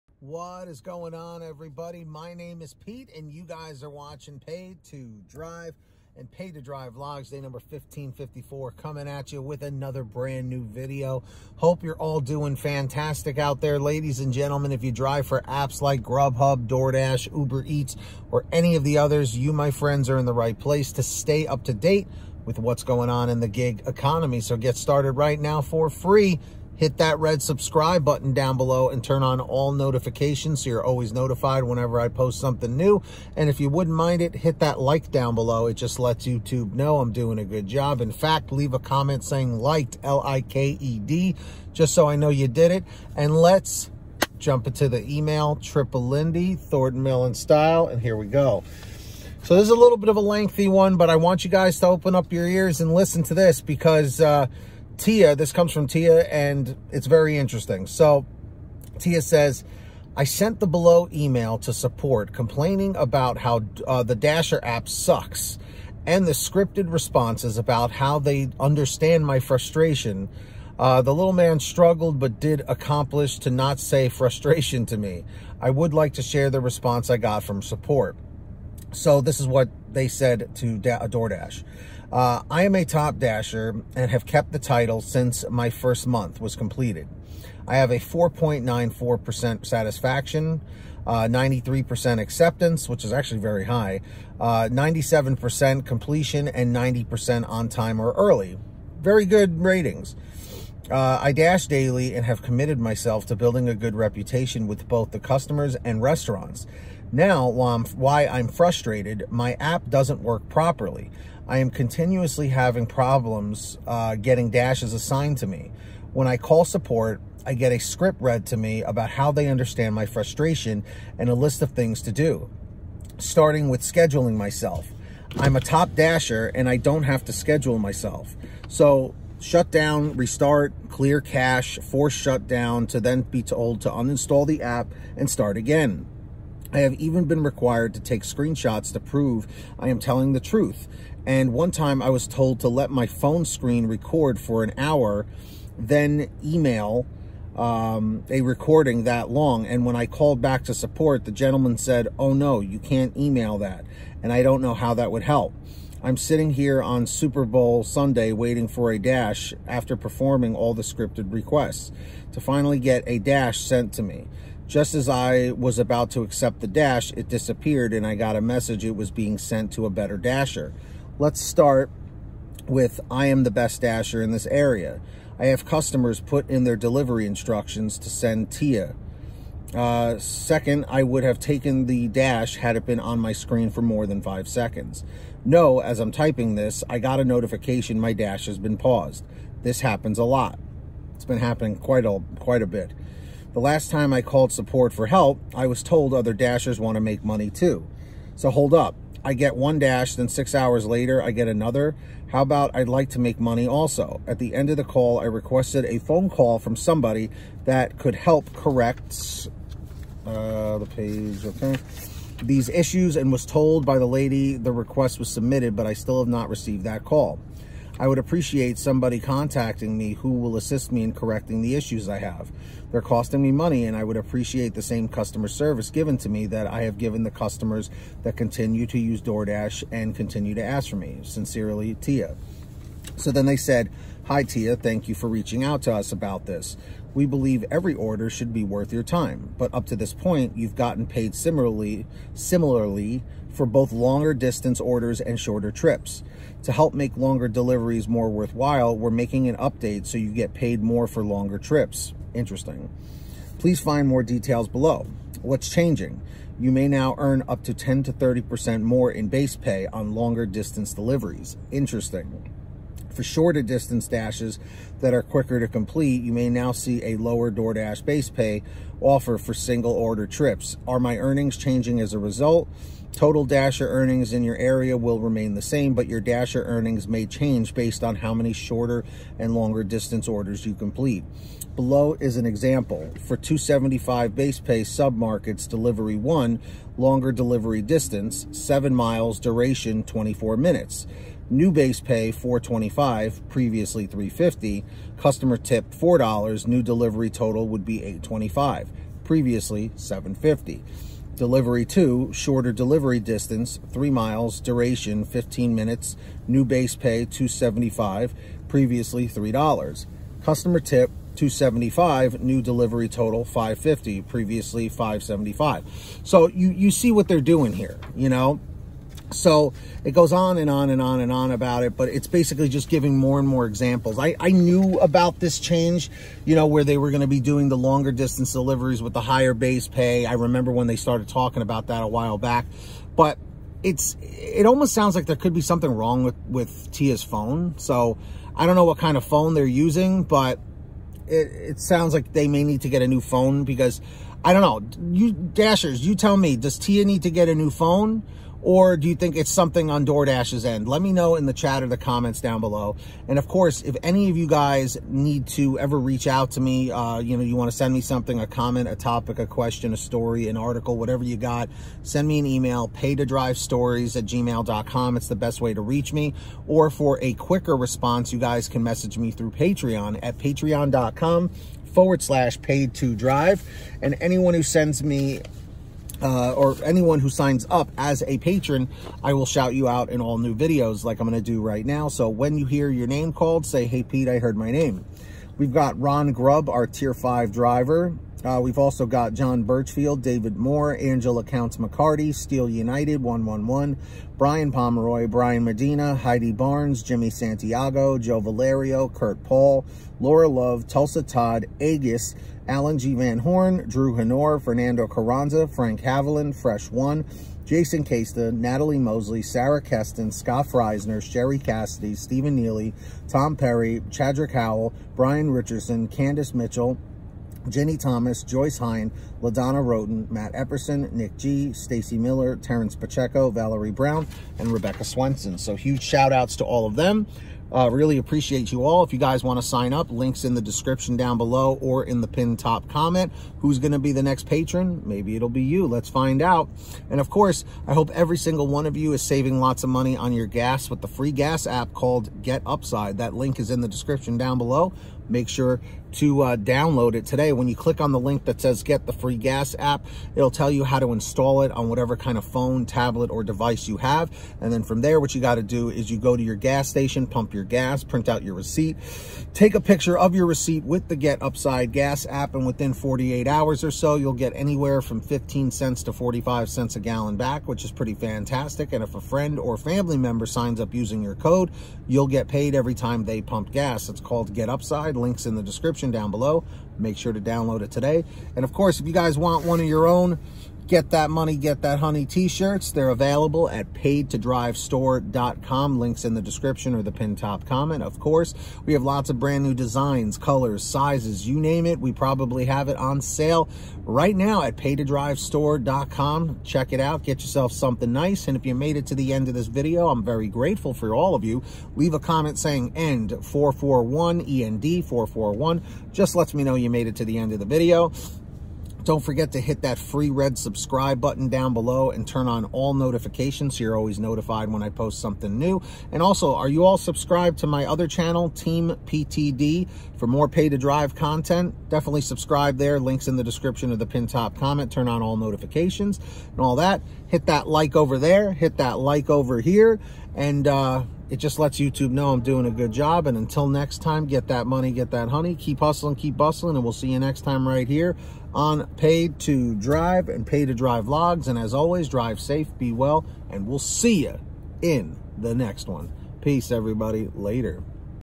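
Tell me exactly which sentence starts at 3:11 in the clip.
It's been happening quite a, quite a bit.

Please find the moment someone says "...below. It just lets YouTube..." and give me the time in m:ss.
0:35.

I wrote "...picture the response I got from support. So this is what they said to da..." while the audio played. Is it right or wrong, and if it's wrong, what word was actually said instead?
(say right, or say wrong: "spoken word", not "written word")
wrong: "share", not "picture".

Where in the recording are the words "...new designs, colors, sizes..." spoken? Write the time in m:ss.
8:09.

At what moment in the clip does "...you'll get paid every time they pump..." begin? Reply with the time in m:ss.
7:52.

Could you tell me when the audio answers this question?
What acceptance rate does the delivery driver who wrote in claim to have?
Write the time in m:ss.
1:31.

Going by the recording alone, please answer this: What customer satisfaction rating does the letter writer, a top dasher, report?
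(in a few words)
4.94%.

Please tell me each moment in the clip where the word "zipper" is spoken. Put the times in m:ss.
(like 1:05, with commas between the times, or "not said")
not said.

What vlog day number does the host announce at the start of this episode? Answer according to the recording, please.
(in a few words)
1554.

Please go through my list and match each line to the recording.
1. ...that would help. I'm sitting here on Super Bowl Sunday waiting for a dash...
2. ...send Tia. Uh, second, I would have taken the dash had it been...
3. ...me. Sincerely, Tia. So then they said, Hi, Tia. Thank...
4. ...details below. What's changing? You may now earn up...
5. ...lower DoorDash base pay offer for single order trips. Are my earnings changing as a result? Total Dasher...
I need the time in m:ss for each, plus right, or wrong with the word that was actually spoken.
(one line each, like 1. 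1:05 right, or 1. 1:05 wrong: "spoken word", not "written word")
1. 2:34 right
2. 2:58 right
3. 3:50 right
4. 4:14 right
5. 4:27 right.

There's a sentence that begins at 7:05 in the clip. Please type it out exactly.
So huge shout outs to all of them.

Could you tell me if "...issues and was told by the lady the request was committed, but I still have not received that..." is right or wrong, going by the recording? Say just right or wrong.
wrong.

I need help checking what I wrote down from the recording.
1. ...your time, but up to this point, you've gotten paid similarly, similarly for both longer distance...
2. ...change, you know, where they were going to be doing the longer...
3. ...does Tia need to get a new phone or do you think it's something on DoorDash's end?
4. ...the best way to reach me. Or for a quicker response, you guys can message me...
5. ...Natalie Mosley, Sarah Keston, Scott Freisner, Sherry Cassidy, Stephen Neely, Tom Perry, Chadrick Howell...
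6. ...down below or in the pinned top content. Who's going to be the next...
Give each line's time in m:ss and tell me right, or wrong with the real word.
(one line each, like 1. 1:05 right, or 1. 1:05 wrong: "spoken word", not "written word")
1. 3:58 right
2. 5:25 right
3. 5:46 right
4. 6:05 right
5. 6:48 right
6. 7:11 wrong: "comment", not "content".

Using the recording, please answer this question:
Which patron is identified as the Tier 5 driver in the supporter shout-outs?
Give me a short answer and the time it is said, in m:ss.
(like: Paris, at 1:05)
Ron Grubb, at 6:25.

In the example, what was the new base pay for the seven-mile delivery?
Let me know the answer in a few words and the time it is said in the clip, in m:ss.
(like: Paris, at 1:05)
$4.25, at 4:52.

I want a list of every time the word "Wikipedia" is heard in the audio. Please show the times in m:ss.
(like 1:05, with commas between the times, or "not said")
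not said.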